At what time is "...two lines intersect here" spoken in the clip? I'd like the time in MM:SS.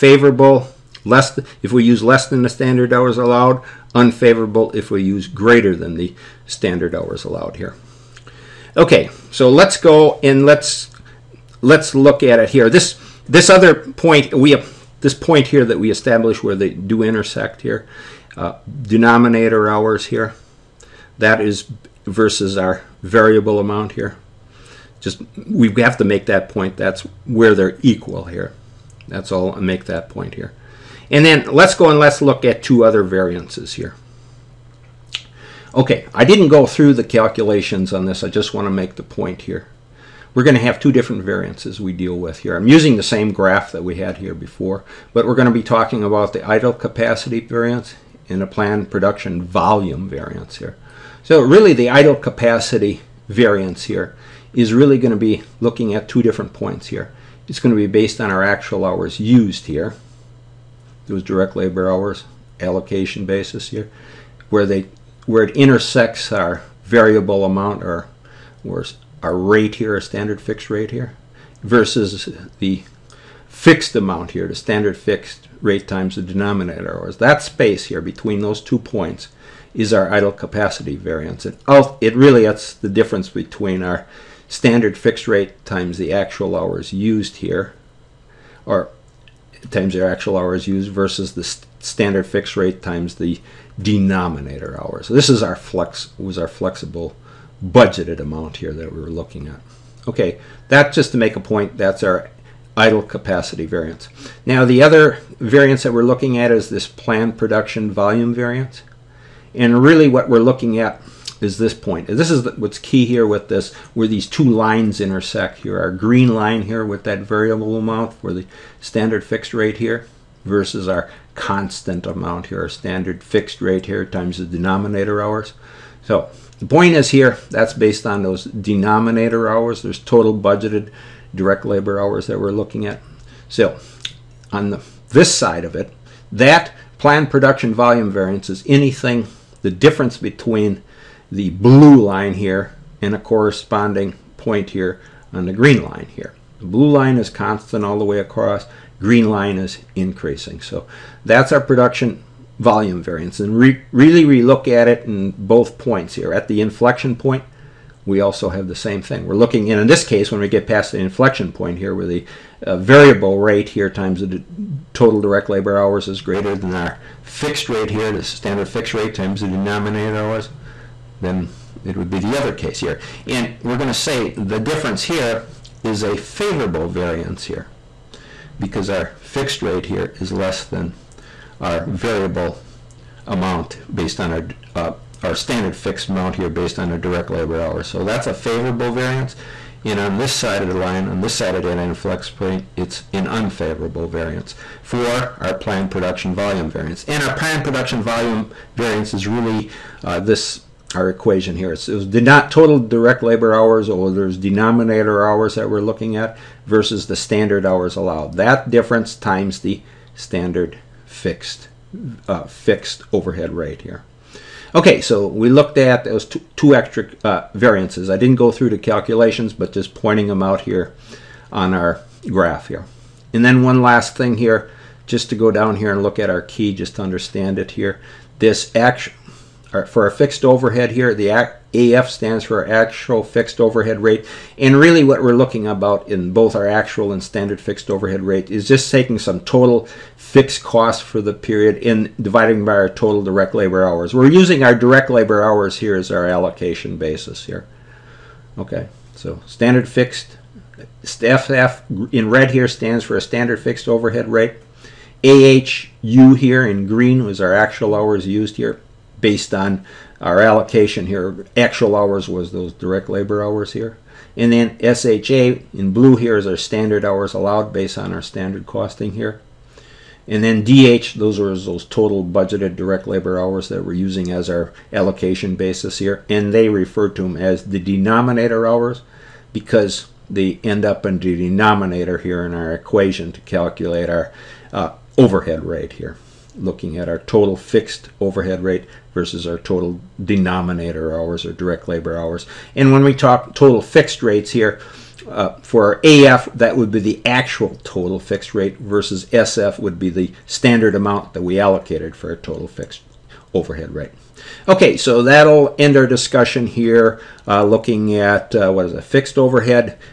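01:54.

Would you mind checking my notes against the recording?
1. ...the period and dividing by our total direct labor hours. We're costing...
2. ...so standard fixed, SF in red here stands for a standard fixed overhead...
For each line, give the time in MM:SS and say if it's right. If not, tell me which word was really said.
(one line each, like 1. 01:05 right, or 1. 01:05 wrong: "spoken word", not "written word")
1. 04:01 wrong: "using", not "costing"
2. 04:09 right.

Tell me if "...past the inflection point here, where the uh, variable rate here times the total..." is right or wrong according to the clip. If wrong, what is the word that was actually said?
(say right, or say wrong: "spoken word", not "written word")
right.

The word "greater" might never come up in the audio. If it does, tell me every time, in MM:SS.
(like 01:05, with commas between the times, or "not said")
00:05, 02:46.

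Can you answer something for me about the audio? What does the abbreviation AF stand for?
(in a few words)
Actual fixed overhead rate.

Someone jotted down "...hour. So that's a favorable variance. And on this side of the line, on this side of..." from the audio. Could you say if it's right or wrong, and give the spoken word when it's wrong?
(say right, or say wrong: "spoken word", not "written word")
right.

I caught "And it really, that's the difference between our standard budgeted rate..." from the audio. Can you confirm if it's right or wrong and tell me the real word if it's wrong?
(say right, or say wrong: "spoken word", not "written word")
wrong: "fixed", not "budgeted".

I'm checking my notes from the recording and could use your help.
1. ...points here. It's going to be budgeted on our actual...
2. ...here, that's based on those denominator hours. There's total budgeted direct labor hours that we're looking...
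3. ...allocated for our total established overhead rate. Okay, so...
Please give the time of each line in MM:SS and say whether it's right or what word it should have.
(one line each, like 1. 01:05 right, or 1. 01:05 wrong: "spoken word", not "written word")
1. 00:56 wrong: "based", not "budgeted"
2. 02:07 right
3. 05:01 wrong: "fixed", not "established".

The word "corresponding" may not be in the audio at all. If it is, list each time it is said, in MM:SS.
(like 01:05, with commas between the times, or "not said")
02:23.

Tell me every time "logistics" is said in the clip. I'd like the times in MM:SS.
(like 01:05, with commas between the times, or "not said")
not said.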